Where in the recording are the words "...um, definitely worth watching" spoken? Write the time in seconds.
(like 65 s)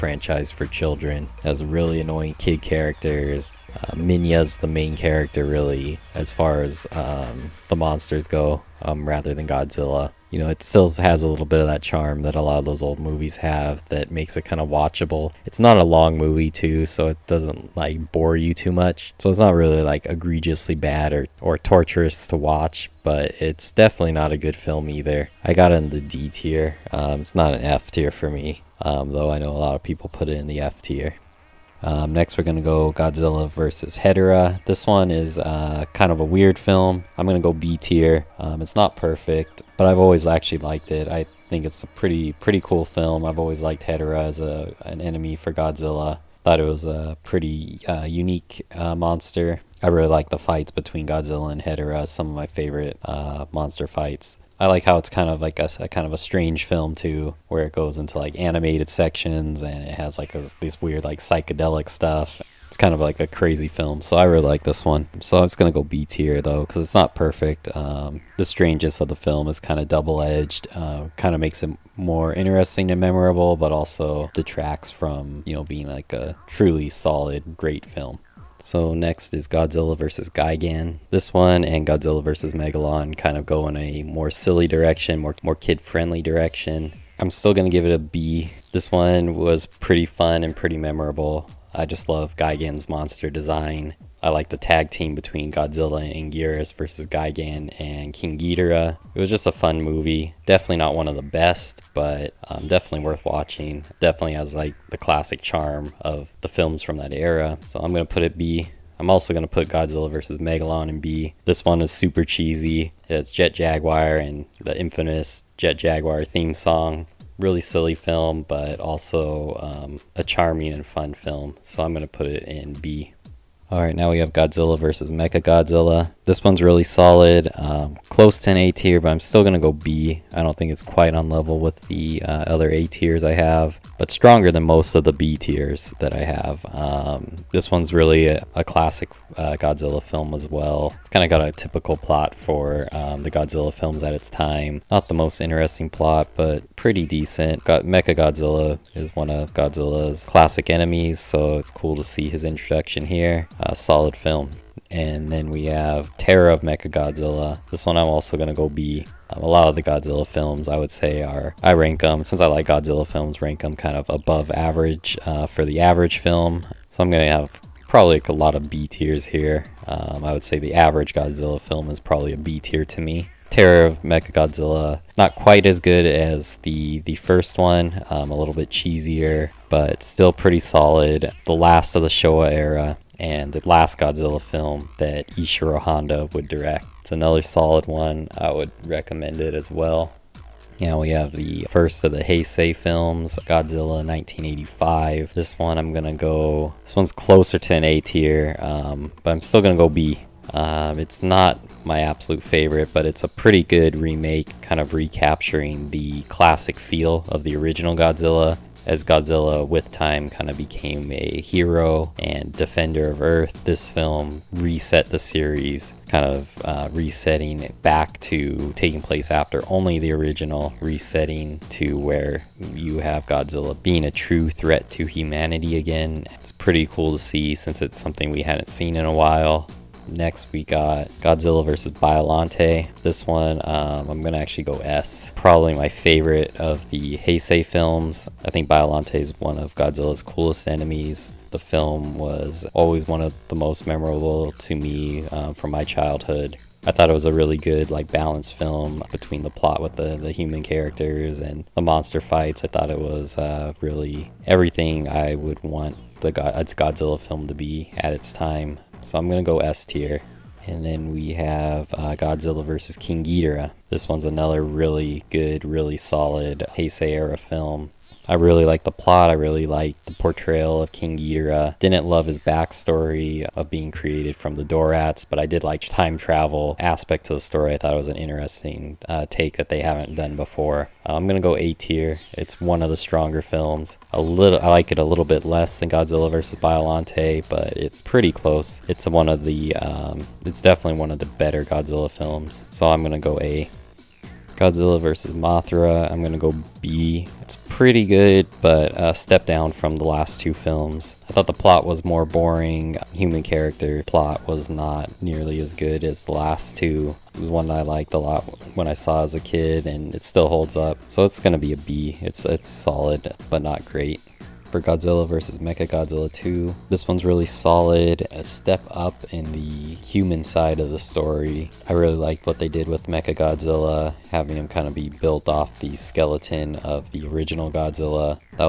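102 s.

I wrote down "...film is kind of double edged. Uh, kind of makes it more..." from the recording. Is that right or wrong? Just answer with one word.
right.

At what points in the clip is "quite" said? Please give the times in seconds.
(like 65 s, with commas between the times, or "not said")
130 s, 175 s.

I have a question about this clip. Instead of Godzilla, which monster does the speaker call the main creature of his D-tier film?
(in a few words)
Minya.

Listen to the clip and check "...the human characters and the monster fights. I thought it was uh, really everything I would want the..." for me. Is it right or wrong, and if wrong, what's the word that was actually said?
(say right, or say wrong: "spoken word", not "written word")
right.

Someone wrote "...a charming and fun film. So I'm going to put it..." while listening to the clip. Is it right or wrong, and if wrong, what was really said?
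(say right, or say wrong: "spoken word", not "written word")
right.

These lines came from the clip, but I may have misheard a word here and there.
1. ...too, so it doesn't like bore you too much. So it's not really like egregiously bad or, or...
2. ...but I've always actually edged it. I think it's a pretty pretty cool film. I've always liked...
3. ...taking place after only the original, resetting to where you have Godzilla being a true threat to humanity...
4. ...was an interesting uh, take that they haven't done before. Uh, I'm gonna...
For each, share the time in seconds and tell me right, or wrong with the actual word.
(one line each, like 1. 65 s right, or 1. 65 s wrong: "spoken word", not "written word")
1. 16 s right
2. 39 s wrong: "liked", not "edged"
3. 218 s right
4. 277 s right.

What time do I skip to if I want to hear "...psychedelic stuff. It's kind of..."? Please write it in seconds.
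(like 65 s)
61 s.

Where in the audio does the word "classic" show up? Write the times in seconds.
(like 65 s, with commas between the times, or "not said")
104 s, 138 s, 150 s, 206 s.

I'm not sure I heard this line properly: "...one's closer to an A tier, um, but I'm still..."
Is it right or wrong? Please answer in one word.
right.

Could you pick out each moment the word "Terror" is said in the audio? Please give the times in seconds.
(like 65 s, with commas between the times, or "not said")
156 s, 173 s.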